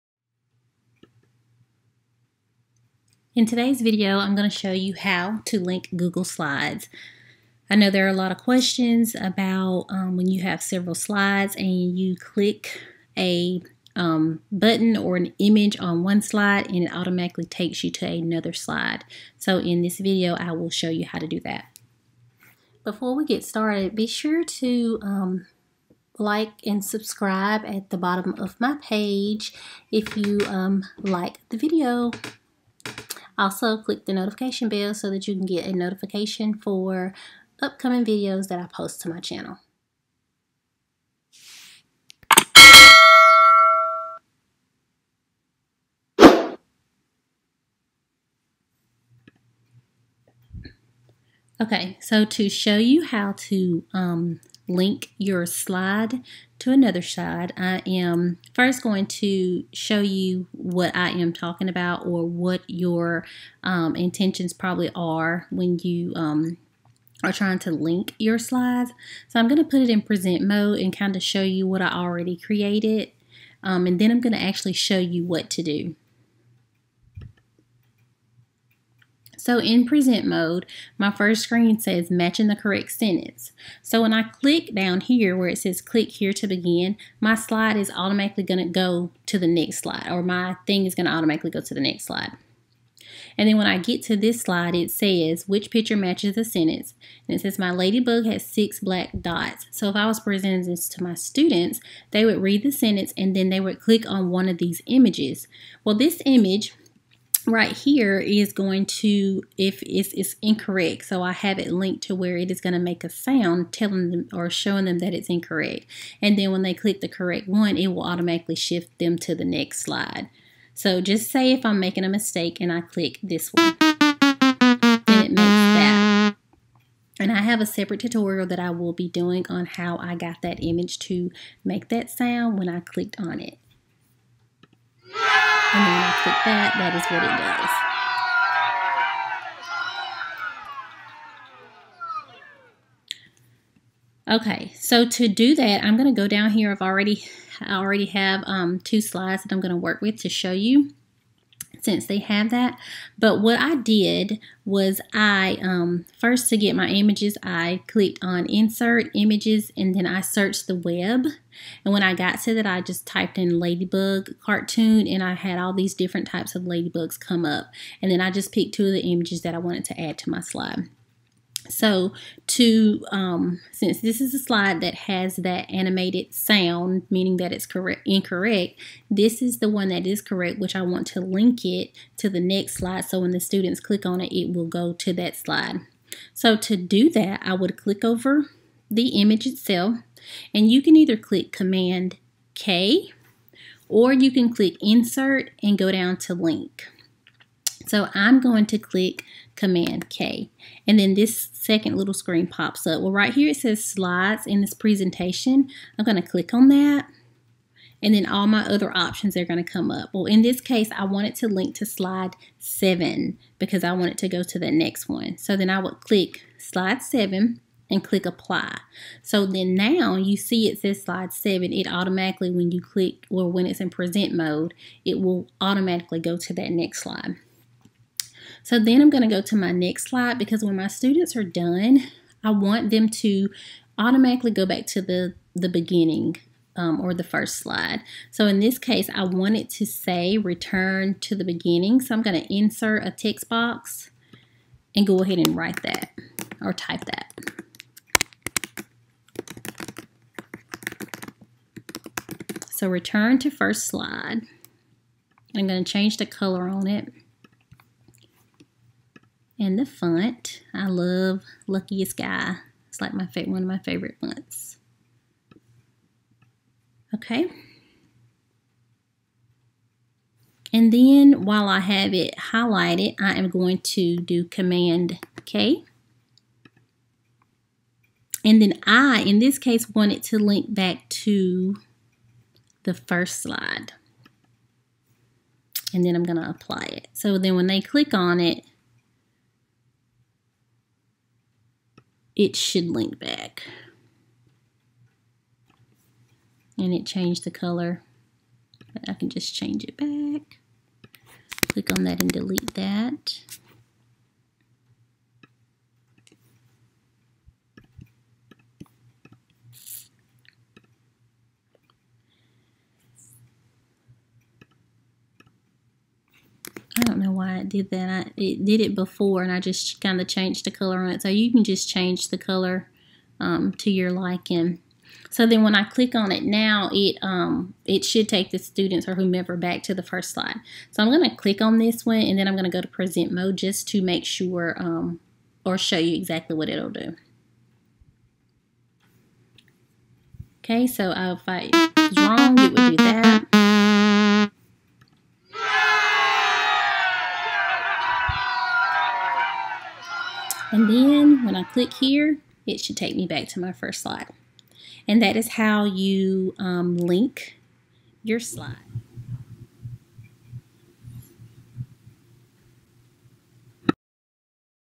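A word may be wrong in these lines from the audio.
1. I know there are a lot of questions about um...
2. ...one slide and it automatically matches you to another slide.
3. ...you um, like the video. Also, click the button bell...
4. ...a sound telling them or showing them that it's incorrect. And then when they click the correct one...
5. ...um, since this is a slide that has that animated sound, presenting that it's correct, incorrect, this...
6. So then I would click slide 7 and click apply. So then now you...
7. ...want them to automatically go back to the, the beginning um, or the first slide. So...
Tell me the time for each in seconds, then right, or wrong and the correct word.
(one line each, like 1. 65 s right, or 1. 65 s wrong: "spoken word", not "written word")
1. 7 s right
2. 16 s wrong: "takes", not "matches"
3. 30 s wrong: "notification", not "button"
4. 113 s right
5. 173 s wrong: "meaning", not "presenting"
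6. 215 s right
7. 232 s right.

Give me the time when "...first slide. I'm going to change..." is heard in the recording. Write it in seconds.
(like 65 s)
253 s.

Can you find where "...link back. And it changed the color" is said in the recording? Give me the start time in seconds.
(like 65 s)
292 s.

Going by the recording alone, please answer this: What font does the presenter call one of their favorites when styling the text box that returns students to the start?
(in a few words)
Luckiest Guy.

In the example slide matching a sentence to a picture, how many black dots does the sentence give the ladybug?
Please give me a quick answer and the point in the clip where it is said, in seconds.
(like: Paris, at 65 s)
6, at 98 s.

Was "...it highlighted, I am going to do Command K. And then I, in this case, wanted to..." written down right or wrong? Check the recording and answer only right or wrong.
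right.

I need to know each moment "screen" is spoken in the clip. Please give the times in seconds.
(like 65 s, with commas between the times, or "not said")
81 s, 202 s.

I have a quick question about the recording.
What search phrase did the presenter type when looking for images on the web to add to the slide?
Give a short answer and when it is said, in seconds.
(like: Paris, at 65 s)
ladybug cartoon, at 163 s.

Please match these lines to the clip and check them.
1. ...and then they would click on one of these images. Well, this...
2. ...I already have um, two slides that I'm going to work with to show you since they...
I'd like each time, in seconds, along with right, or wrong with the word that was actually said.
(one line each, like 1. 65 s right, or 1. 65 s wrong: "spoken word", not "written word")
1. 103 s right
2. 147 s right.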